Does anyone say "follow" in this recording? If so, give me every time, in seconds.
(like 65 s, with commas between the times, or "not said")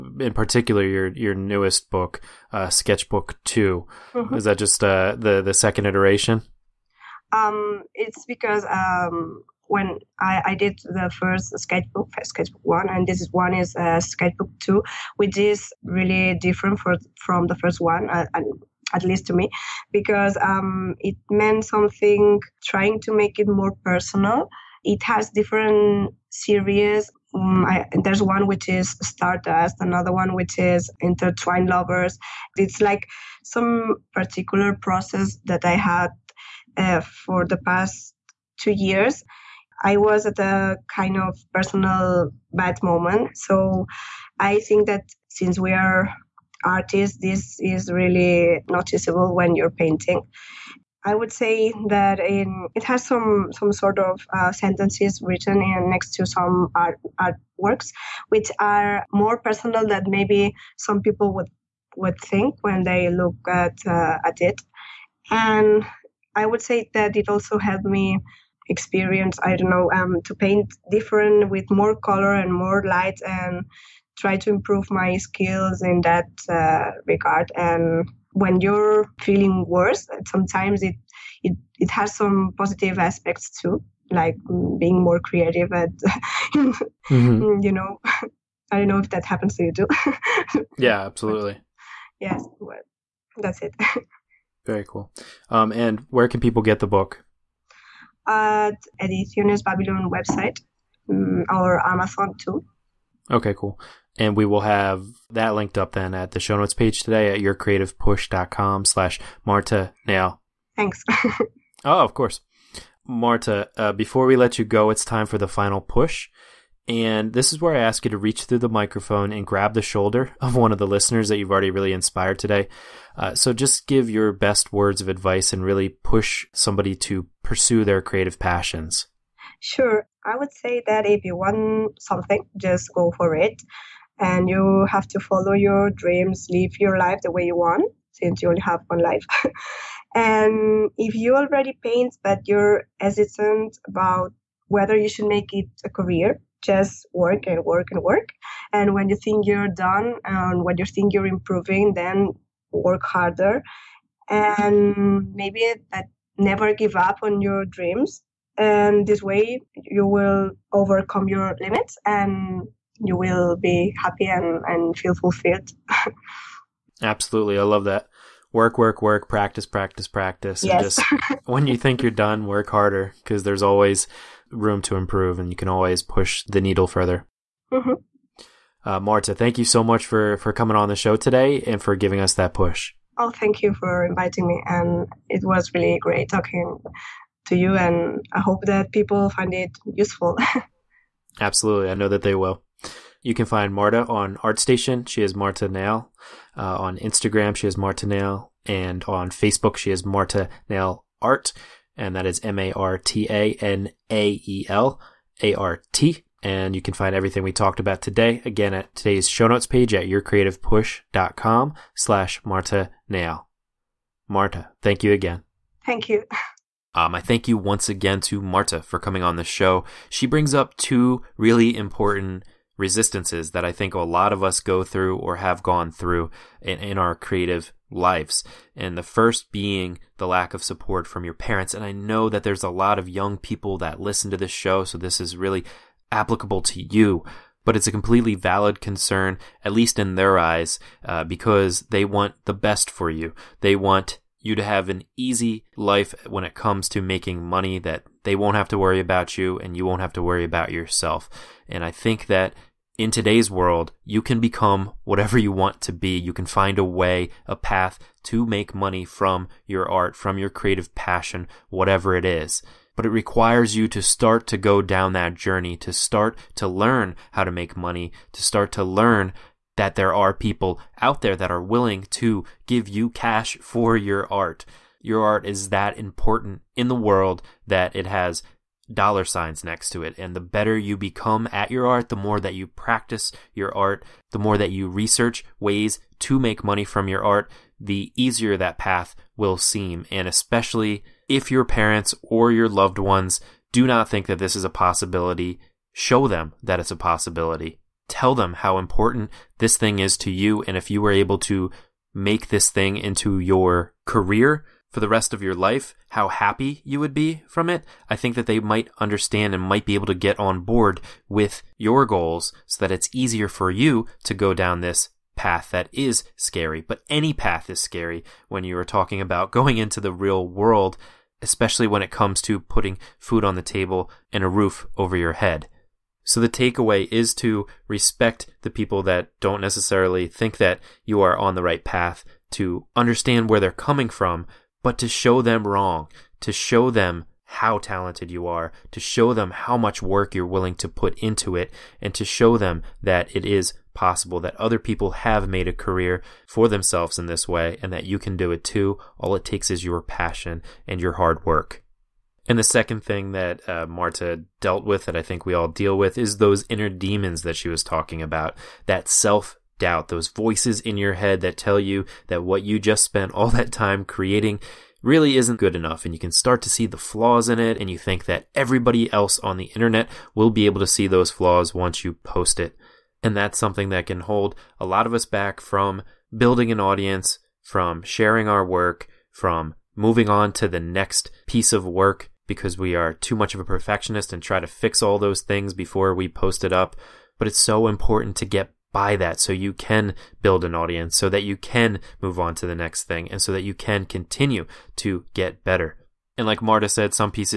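135 s.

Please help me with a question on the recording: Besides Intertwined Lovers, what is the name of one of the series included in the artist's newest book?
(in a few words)
Stardust.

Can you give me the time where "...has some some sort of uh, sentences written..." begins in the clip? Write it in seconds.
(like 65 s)
52 s.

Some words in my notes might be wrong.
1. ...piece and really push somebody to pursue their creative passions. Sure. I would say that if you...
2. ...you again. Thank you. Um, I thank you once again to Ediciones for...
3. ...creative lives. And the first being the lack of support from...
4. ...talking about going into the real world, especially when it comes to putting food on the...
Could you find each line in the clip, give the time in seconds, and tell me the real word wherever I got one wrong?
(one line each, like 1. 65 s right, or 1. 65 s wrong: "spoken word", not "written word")
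1. 125 s wrong: "advice", not "piece"
2. 215 s wrong: "Marta", not "Ediciones"
3. 227 s right
4. 318 s right.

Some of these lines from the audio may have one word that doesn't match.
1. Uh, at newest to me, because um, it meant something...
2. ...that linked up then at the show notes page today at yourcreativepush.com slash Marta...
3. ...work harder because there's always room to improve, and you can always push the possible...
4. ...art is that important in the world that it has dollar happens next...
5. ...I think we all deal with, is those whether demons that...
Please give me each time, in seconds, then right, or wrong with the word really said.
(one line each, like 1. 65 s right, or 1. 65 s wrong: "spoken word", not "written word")
1. 18 s wrong: "least", not "newest"
2. 105 s right
3. 172 s wrong: "needle", not "possible"
4. 275 s wrong: "signs", not "happens"
5. 355 s wrong: "inner", not "whether".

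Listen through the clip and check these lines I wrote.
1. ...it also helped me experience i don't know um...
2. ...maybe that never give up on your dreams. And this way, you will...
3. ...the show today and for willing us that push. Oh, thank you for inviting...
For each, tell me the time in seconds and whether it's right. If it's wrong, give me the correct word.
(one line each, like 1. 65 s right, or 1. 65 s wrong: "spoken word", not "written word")
1. 67 s right
2. 155 s right
3. 180 s wrong: "giving", not "willing".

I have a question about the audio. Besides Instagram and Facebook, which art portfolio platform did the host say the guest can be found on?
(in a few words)
ArtStation.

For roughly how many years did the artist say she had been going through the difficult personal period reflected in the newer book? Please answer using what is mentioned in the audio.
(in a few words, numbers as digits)
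2.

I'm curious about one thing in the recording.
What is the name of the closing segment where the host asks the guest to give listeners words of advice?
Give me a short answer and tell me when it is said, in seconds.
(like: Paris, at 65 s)
the final push, at 115 s.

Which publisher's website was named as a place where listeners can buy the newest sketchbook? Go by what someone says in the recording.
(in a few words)
Ediciones Babylon.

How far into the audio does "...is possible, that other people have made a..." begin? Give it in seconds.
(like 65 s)
343 s.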